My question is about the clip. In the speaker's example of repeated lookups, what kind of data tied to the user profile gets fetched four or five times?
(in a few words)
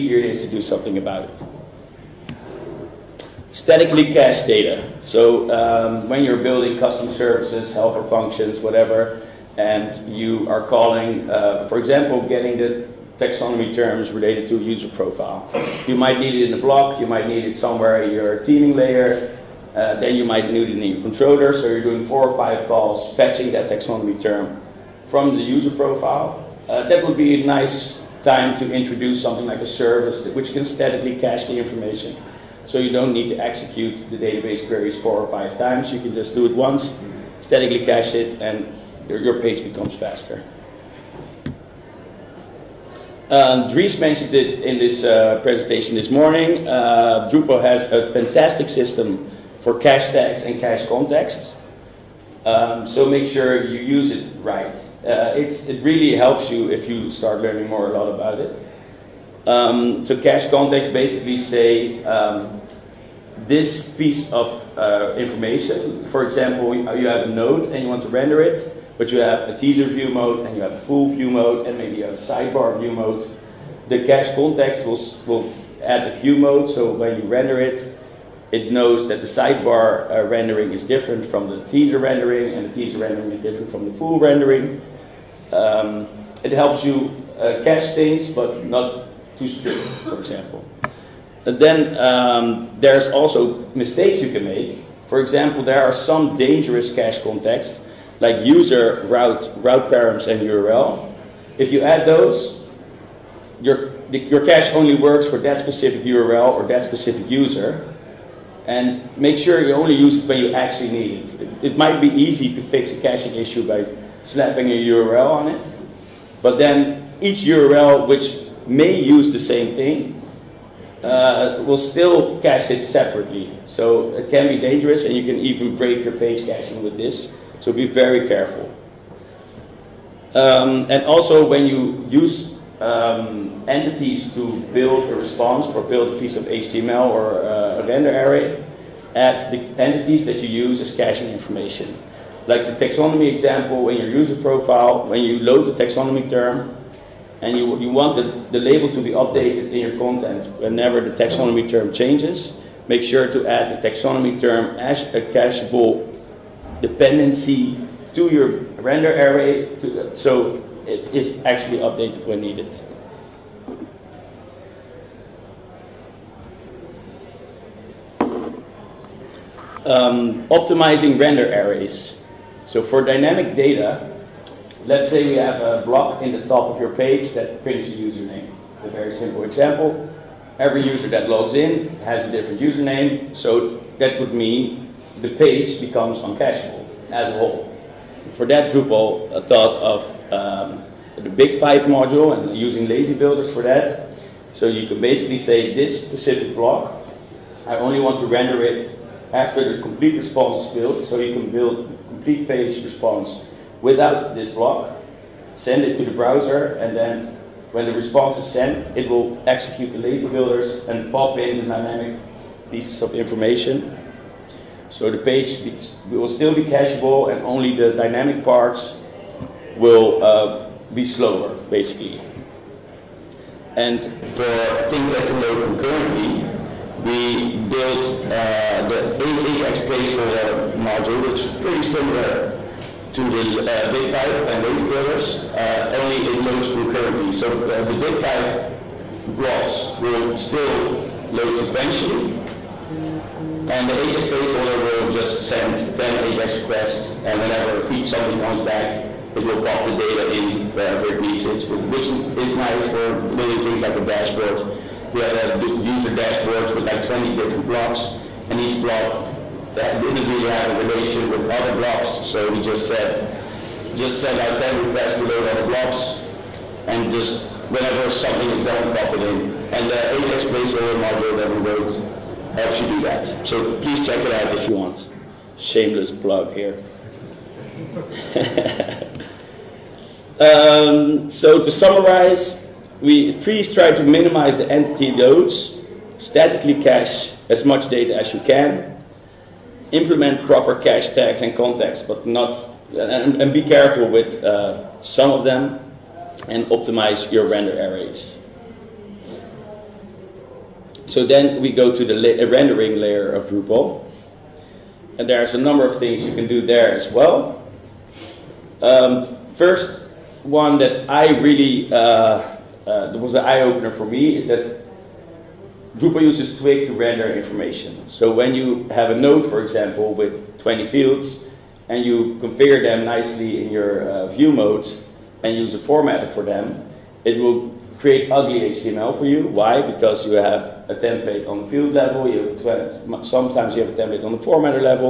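taxonomy terms.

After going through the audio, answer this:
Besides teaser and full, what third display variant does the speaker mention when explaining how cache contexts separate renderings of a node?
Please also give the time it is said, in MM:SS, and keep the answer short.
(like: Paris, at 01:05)
sidebar view mode, at 01:12.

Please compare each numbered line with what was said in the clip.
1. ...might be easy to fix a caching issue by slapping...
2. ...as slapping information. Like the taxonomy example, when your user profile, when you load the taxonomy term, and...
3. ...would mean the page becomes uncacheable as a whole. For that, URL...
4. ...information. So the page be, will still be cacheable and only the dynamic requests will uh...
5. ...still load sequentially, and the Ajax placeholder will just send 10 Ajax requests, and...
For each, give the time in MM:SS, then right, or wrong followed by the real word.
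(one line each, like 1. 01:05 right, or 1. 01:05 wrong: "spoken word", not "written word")
1. 01:51 right
2. 02:20 wrong: "caching", not "slapping"
3. 03:04 wrong: "Drupal", not "URL"
4. 03:33 wrong: "parts", not "requests"
5. 04:00 right.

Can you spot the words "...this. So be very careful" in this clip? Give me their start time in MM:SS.
02:06.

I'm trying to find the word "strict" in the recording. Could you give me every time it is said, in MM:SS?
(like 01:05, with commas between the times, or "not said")
01:29.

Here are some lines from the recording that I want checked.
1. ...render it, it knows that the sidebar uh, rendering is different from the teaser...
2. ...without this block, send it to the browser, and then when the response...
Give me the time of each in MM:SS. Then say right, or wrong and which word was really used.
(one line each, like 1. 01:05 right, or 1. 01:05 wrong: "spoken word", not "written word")
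1. 01:17 right
2. 03:23 right.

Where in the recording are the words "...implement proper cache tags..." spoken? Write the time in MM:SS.
04:49.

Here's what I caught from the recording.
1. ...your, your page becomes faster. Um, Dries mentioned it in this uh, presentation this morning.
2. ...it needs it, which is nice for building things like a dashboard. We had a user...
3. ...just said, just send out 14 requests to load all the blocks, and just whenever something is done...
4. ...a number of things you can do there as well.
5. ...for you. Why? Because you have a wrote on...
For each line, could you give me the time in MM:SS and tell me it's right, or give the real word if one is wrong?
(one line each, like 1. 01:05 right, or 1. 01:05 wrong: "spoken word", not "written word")
1. 00:39 right
2. 04:11 right
3. 04:22 wrong: "10", not "14"
4. 05:05 right
5. 05:29 wrong: "template", not "wrote".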